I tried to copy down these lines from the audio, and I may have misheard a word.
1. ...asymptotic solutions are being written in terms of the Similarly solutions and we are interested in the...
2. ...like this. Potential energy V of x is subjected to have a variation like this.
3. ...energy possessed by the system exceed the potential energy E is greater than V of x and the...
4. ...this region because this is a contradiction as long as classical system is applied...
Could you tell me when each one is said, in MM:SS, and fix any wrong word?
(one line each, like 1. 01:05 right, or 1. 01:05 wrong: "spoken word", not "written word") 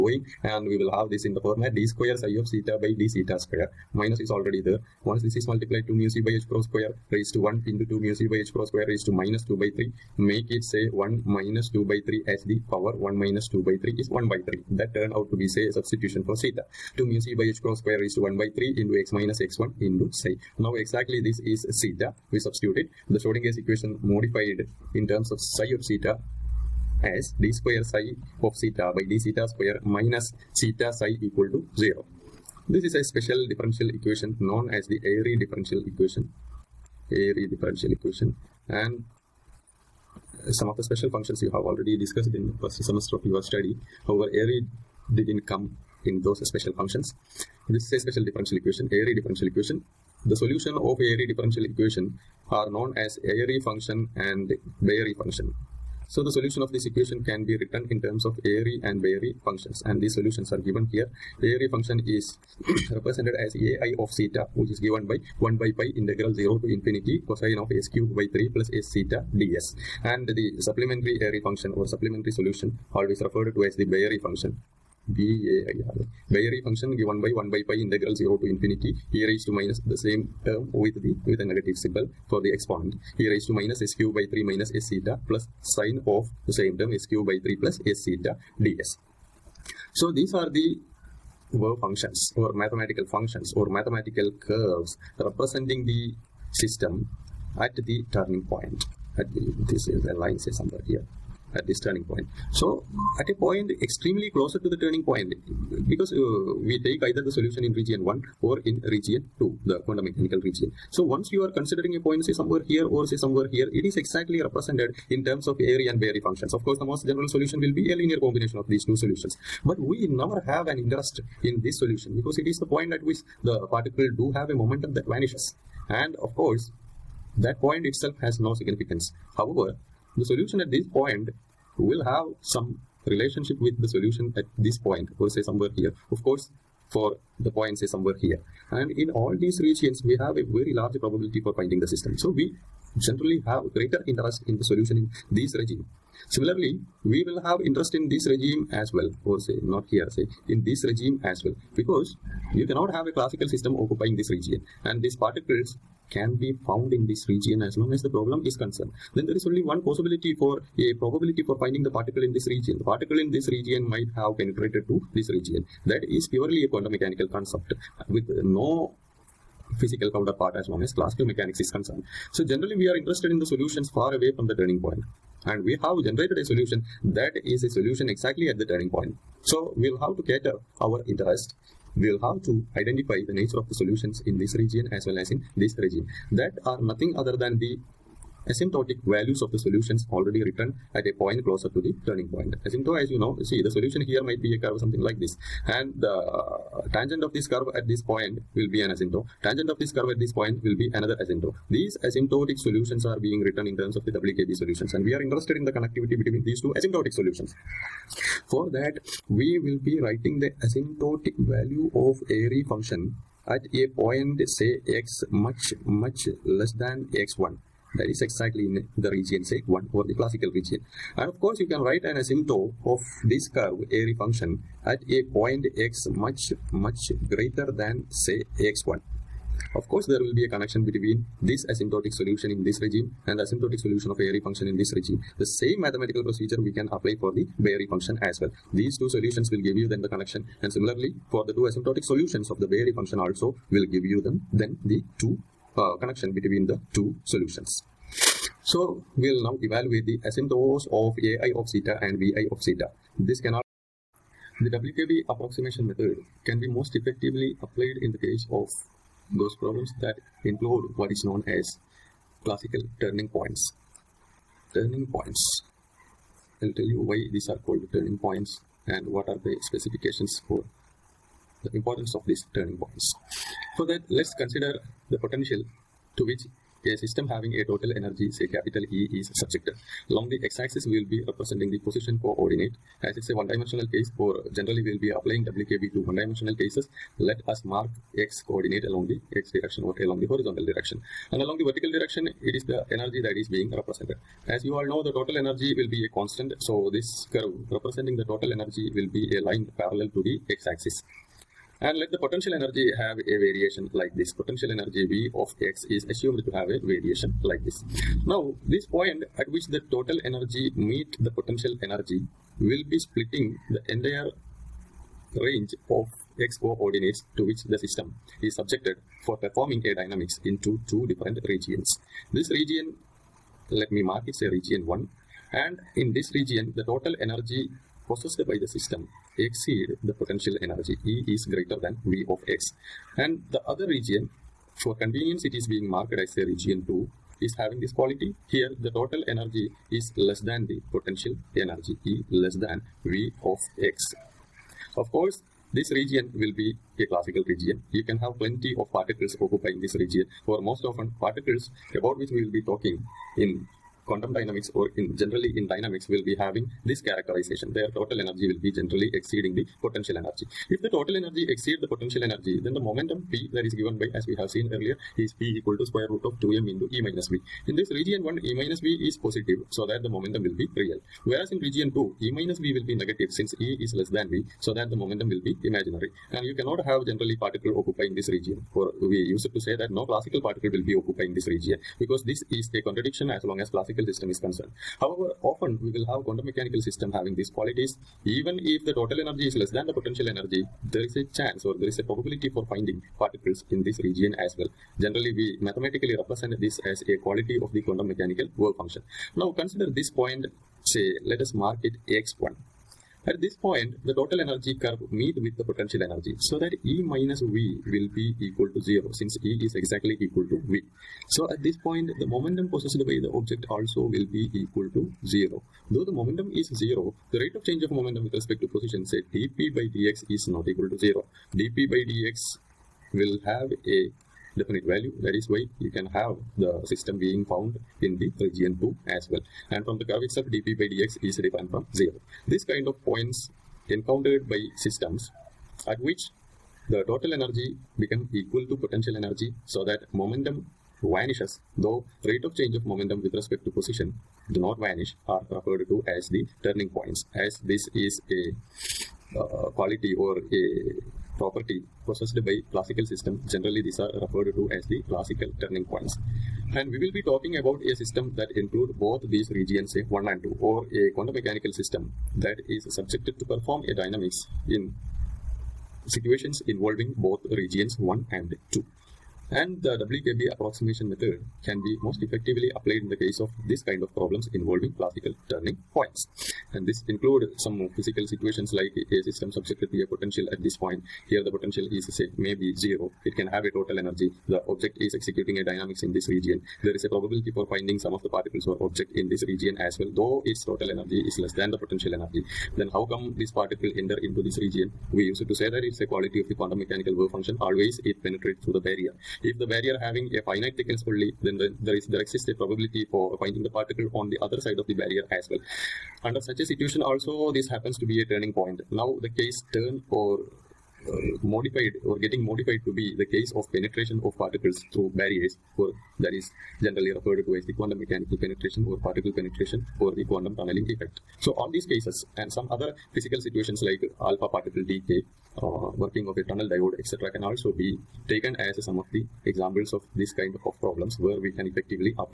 1. 03:22 wrong: "WKB", not "Similarly"
2. 05:03 wrong: "assumed", not "subjected"
3. 05:27 right
4. 06:21 wrong: "concerned", not "applied".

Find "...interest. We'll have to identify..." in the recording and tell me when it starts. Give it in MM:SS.
03:01.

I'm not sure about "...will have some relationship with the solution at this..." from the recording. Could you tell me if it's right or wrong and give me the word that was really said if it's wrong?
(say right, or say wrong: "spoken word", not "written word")
right.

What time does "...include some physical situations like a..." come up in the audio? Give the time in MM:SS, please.
07:57.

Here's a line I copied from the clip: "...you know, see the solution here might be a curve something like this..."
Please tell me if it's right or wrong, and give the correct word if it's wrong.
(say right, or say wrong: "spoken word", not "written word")
right.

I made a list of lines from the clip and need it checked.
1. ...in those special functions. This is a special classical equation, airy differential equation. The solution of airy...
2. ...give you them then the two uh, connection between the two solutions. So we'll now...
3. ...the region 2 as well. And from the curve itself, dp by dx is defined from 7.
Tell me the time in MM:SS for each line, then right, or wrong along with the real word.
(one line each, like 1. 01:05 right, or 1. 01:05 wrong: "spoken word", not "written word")
1. 00:46 wrong: "differential", not "classical"
2. 04:03 right
3. 07:08 wrong: "0", not "7".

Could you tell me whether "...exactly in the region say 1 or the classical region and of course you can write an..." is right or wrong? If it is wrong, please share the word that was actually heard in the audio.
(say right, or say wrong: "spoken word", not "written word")
right.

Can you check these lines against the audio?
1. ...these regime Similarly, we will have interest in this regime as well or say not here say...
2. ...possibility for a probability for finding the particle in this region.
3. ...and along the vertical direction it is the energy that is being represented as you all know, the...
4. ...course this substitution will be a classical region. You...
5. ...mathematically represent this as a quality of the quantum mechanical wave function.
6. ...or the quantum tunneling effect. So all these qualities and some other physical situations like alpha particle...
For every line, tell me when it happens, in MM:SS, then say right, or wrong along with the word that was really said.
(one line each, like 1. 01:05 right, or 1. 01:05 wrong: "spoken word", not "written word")
1. 02:25 right
2. 02:39 right
3. 04:51 right
4. 05:45 wrong: "region", not "substitution"
5. 06:35 right
6. 08:40 wrong: "cases", not "qualities".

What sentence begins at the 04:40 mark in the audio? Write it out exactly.
Along the x-axis, we will be representing the position coordinate.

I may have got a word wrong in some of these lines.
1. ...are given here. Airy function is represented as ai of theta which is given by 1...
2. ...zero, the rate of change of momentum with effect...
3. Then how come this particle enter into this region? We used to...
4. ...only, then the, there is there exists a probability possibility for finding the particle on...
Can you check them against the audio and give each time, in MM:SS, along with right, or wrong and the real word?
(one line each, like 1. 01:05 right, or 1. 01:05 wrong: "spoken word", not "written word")
1. 01:00 right
2. 06:56 wrong: "respect", not "effect"
3. 08:12 right
4. 08:21 right.